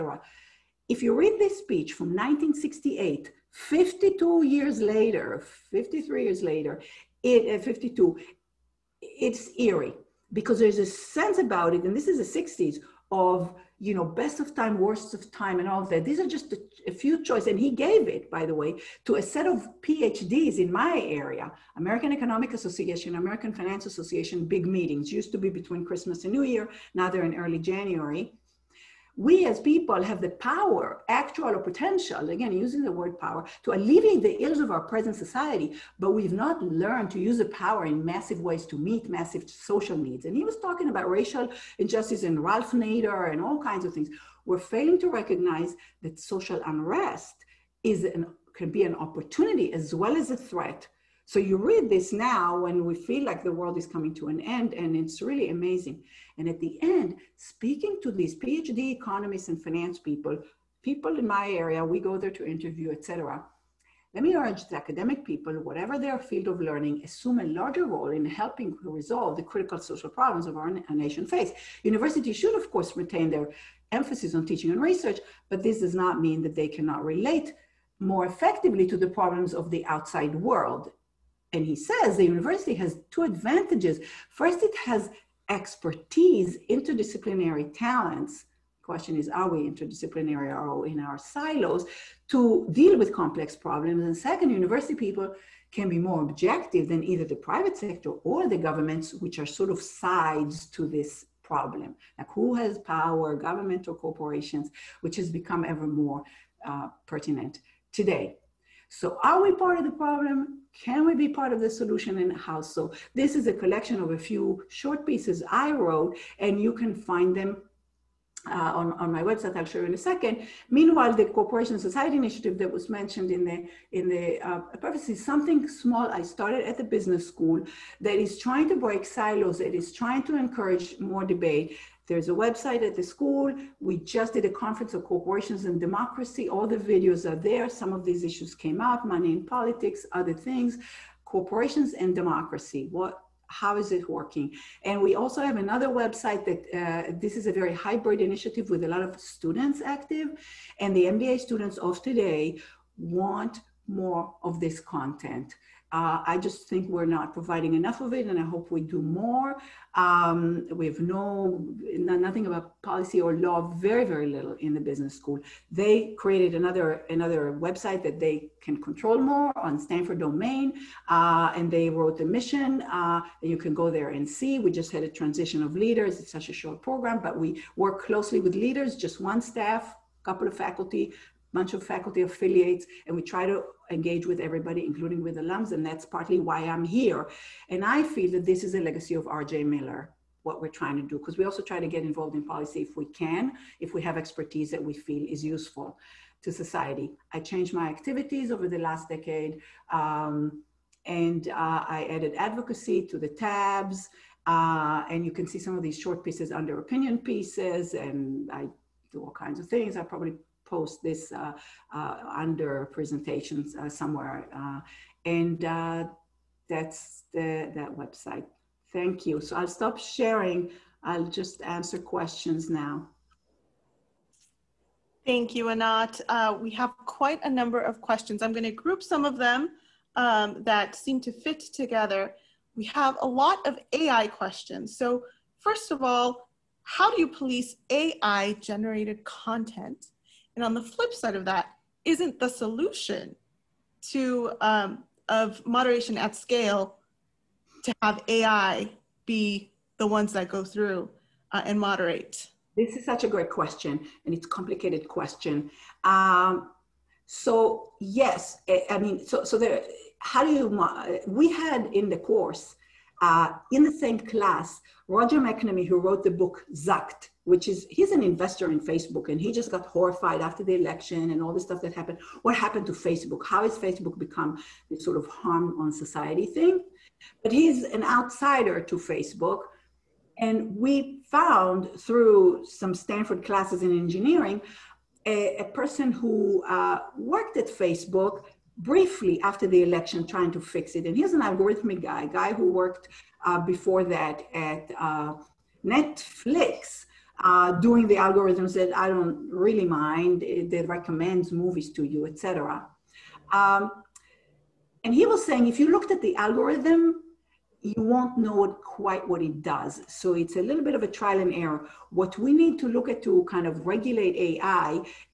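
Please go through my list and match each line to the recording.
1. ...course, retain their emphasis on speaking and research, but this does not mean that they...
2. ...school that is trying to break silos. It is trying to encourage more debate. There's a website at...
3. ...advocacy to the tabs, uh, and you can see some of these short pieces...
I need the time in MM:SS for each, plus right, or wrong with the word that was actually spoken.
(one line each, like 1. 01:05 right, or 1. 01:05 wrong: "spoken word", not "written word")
1. 01:12 wrong: "teaching", not "speaking"
2. 02:07 right
3. 03:22 right.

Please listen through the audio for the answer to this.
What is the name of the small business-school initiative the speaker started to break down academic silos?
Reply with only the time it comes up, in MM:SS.
02:01.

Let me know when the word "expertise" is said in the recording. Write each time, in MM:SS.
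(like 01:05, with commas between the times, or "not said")
01:25, 03:14.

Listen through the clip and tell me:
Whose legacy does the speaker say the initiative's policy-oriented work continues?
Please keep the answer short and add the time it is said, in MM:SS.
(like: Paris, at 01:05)
Arjay Miller, at 03:09.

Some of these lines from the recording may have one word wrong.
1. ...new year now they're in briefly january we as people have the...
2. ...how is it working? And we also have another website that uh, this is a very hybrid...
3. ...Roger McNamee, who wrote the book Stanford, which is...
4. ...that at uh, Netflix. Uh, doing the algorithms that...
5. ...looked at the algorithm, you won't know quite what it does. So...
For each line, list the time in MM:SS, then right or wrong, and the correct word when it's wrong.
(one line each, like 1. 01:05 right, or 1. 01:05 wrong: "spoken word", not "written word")
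1. 00:26 wrong: "early", not "briefly"
2. 02:23 right
3. 04:25 wrong: "Zucked", not "Stanford"
4. 04:54 right
5. 05:05 right.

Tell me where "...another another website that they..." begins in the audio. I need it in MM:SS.
02:46.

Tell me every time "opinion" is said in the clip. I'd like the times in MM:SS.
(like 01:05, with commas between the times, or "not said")
03:26.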